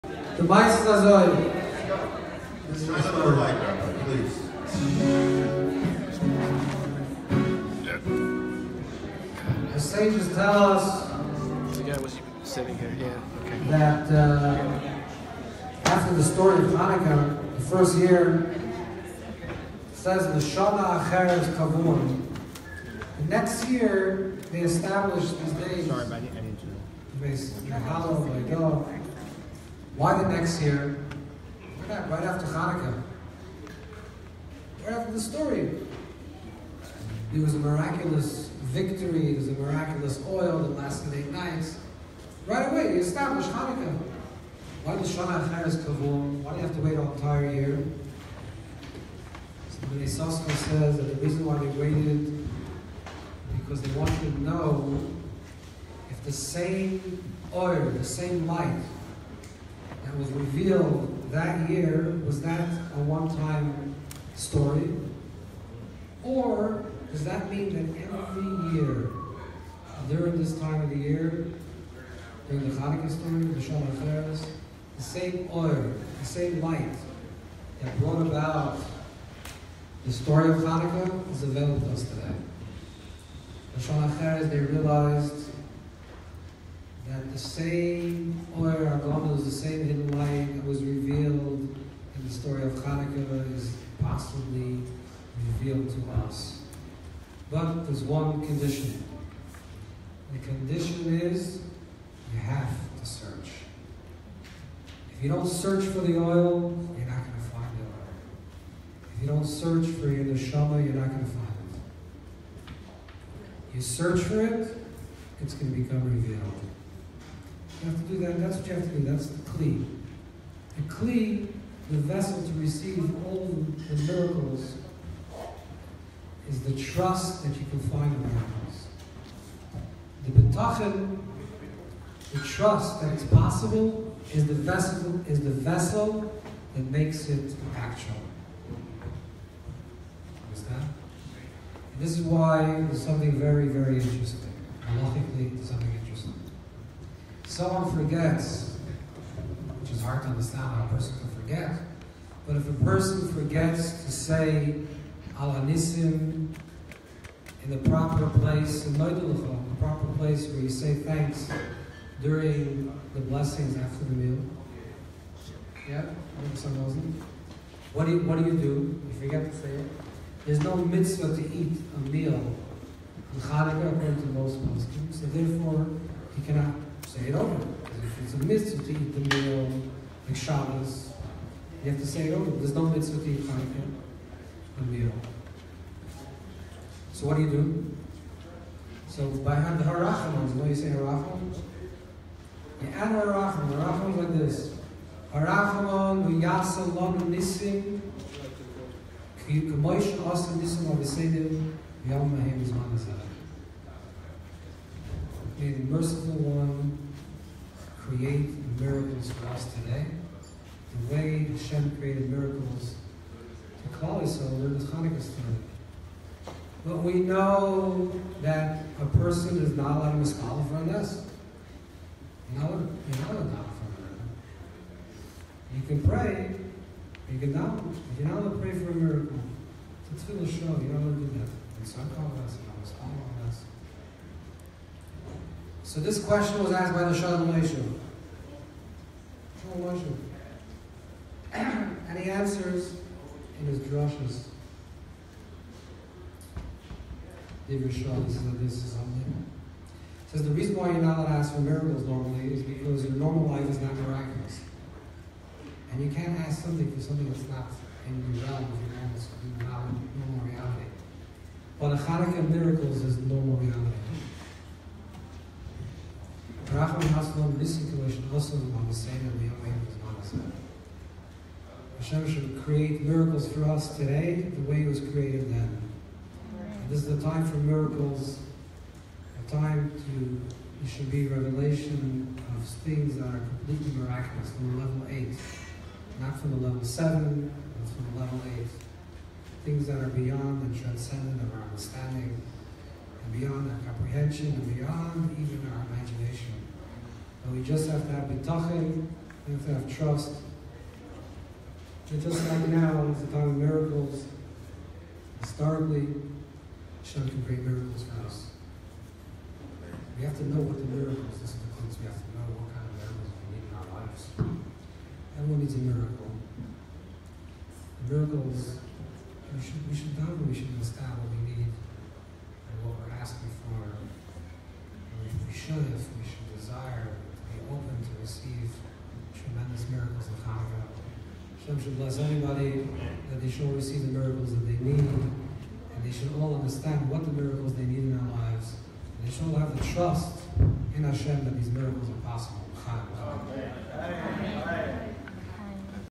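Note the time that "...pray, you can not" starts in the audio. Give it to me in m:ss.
3:46.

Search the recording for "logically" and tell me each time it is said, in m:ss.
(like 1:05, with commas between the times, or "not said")
2:25.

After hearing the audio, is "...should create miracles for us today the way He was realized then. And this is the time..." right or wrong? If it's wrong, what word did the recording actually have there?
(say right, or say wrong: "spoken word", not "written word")
wrong: "created", not "realized".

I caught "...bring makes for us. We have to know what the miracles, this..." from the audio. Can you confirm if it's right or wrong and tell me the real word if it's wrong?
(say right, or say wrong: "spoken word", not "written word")
wrong: "miracles", not "makes".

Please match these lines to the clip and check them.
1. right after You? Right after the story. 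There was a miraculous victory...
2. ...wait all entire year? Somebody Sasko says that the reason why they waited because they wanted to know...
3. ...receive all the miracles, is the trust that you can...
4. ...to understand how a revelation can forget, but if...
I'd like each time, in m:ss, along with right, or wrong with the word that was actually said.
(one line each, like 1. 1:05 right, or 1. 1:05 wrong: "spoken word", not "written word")
1. 0:31 wrong: "Hanukkah", not "You"
2. 0:46 right
3. 2:02 right
4. 2:30 wrong: "person", not "revelation".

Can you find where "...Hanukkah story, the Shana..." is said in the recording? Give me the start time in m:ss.
1:12.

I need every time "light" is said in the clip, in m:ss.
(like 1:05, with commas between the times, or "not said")
0:58, 1:16, 1:30.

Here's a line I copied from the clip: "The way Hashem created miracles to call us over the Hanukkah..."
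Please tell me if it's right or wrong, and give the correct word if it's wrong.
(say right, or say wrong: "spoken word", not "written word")
right.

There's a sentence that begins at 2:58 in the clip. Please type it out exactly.
if it's a mitzvah to eat the meal, like Shabbos, you have to say it oh, over.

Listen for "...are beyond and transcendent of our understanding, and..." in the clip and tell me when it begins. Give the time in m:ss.
4:49.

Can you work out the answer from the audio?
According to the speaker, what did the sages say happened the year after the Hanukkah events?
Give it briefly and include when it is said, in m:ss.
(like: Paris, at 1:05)
They established these days, at 0:24.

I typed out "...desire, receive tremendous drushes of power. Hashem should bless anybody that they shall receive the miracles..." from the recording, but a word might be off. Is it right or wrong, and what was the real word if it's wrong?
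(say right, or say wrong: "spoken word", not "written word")
wrong: "miracles", not "drushes".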